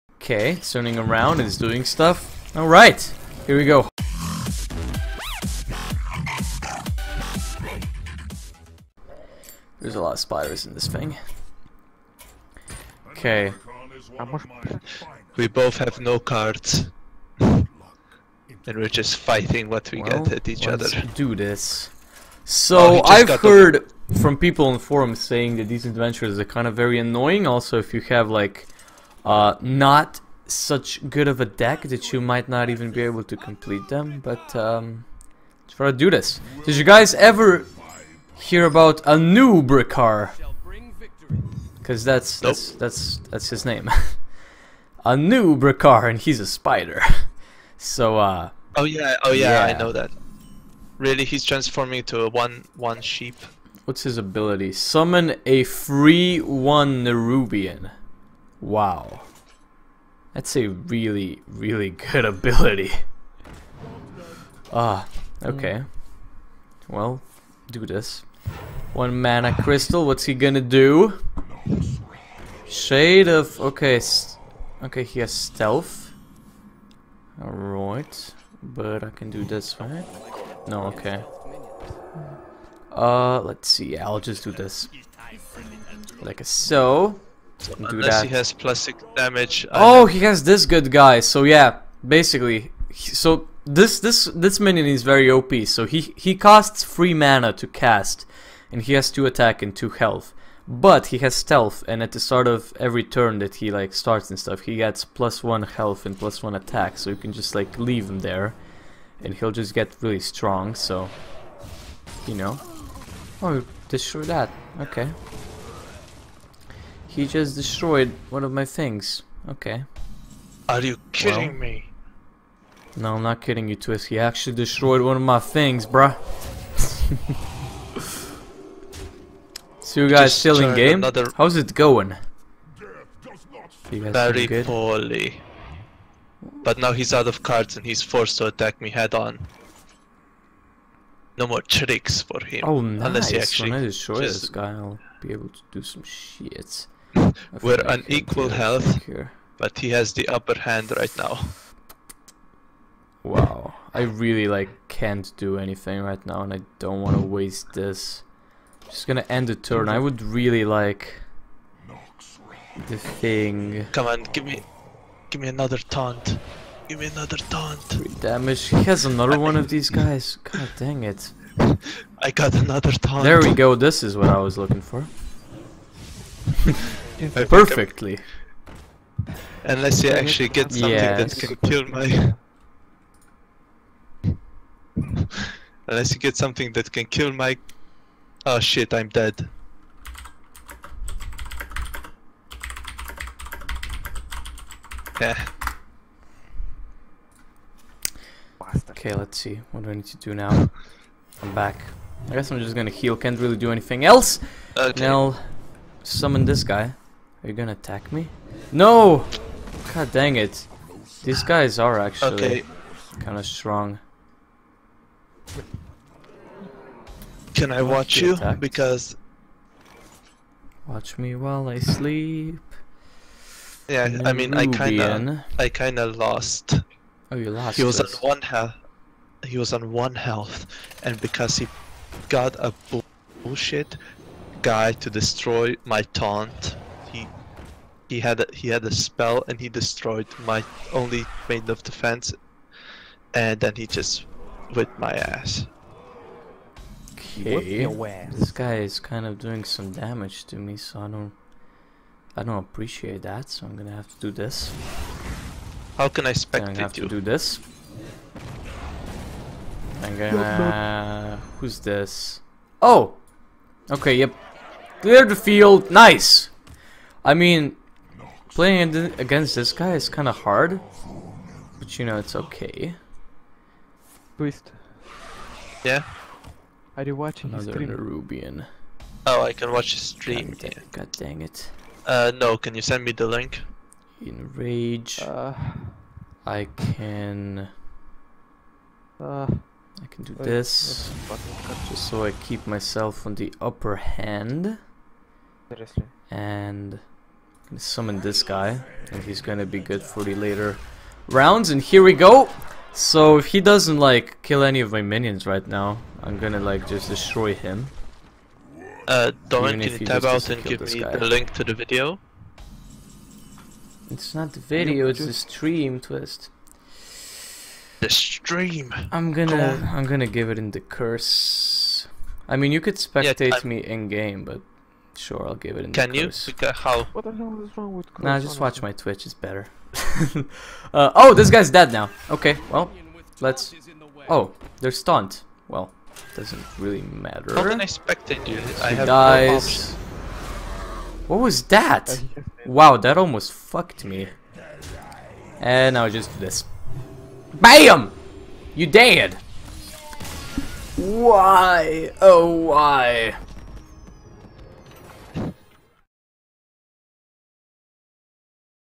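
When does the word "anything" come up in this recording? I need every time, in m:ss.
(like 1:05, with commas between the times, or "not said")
2:35, 3:23.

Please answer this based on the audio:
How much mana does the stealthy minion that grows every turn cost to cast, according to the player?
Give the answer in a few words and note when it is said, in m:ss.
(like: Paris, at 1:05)
3, at 1:36.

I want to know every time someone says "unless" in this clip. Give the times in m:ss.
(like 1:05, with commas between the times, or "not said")
1:27, 2:23, 2:59, 3:05.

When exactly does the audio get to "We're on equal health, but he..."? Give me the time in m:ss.
2:27.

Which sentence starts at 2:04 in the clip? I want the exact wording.
He actually destroyed one of my things, bruh.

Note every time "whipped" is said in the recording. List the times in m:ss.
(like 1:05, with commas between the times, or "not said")
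4:04.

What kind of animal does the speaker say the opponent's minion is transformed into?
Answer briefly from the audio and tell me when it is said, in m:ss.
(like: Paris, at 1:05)
sheep, at 0:53.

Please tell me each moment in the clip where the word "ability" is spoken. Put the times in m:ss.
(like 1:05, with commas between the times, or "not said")
0:54, 1:02.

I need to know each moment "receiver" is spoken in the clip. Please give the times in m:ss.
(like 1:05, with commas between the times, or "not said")
not said.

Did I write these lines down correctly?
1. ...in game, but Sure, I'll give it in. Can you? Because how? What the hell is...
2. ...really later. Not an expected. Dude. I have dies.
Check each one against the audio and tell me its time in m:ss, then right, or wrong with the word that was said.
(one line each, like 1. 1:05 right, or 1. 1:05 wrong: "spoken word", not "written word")
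1. 5:23 right
2. 5:36 wrong: "matter", not "later".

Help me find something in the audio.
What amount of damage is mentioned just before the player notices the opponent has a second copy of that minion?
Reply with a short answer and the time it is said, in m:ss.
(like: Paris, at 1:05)
3, at 2:47.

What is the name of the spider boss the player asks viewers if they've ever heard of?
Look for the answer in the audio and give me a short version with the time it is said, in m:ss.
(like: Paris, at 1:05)
Anub'Rekhan, at 0:39.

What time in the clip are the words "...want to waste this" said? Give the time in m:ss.
2:37.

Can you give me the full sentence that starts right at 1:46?
So you can just like leave him there, and he'll just get really strong.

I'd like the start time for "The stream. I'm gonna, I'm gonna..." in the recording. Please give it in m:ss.
5:18.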